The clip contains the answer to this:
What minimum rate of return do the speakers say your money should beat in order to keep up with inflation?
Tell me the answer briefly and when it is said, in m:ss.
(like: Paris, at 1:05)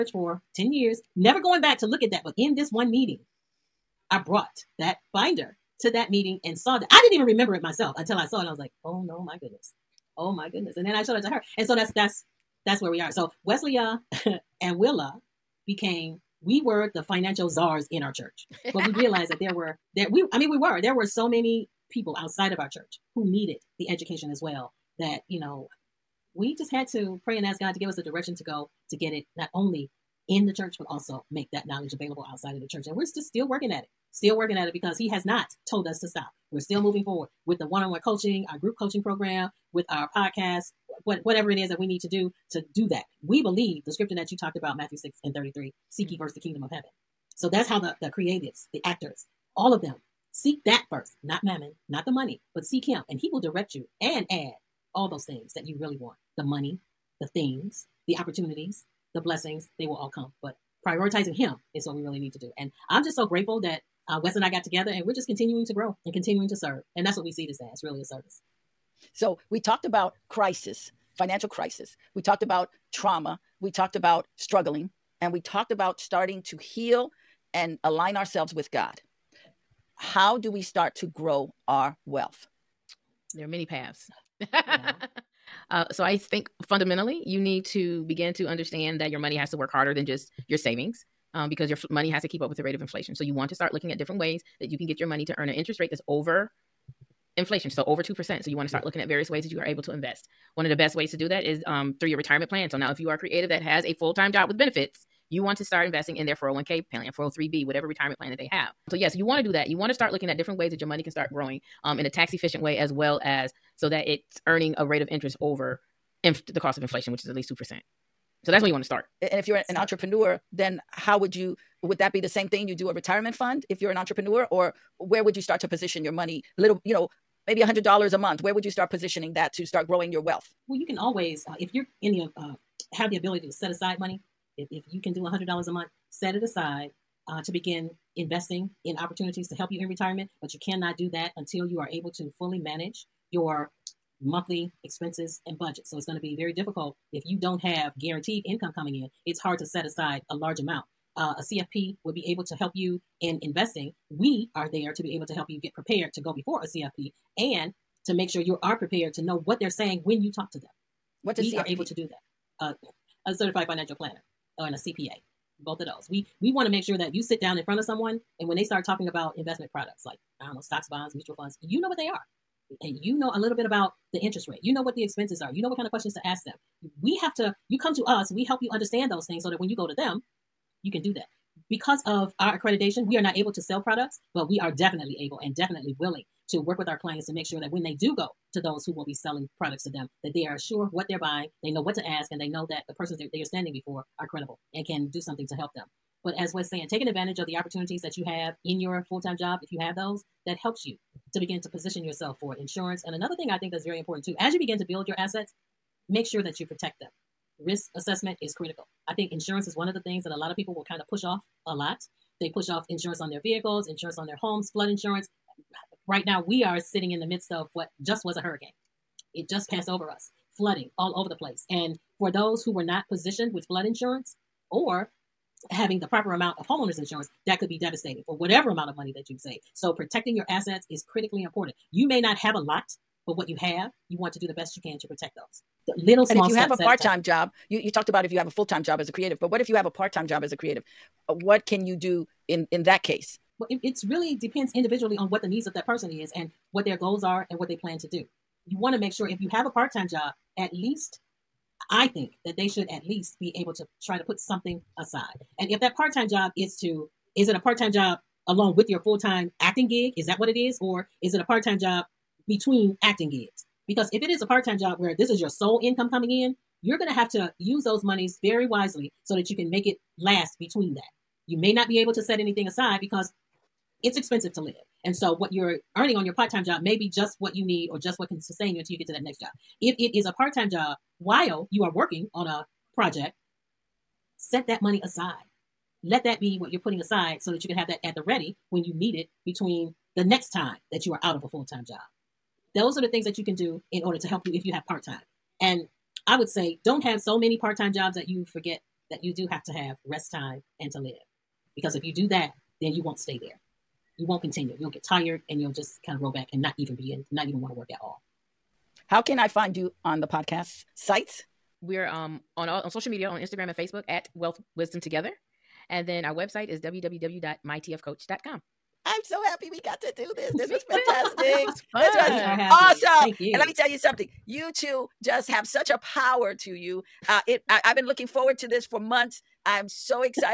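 2%, at 1:38.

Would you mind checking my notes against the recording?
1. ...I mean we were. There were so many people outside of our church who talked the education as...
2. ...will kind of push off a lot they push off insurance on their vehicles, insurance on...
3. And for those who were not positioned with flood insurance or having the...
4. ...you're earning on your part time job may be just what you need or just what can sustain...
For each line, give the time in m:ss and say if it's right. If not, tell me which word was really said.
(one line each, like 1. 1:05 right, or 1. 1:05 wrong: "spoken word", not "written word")
1. 0:20 wrong: "needed", not "talked"
2. 3:30 right
3. 3:41 right
4. 4:35 right.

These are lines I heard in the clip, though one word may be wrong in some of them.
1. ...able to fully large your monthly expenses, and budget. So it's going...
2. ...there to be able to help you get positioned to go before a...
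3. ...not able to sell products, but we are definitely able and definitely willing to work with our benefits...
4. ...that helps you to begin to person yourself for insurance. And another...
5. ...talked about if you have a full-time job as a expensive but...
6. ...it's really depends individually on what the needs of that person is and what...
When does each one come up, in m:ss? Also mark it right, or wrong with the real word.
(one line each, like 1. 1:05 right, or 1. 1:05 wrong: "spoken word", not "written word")
1. 2:21 wrong: "manage", not "large"
2. 2:34 wrong: "prepared", not "positioned"
3. 3:03 wrong: "clients", not "benefits"
4. 3:20 wrong: "position", not "person"
5. 3:57 wrong: "creative", not "expensive"
6. 4:03 right.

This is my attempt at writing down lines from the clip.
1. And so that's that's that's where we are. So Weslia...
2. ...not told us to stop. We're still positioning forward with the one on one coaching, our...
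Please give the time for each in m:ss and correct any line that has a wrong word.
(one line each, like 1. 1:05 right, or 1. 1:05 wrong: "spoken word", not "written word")
1. 0:11 right
2. 0:35 wrong: "moving", not "positioning".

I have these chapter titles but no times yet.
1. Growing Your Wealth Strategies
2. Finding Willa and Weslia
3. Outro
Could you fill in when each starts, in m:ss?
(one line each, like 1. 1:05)
1. 1:19
2. 5:09
3. 5:21.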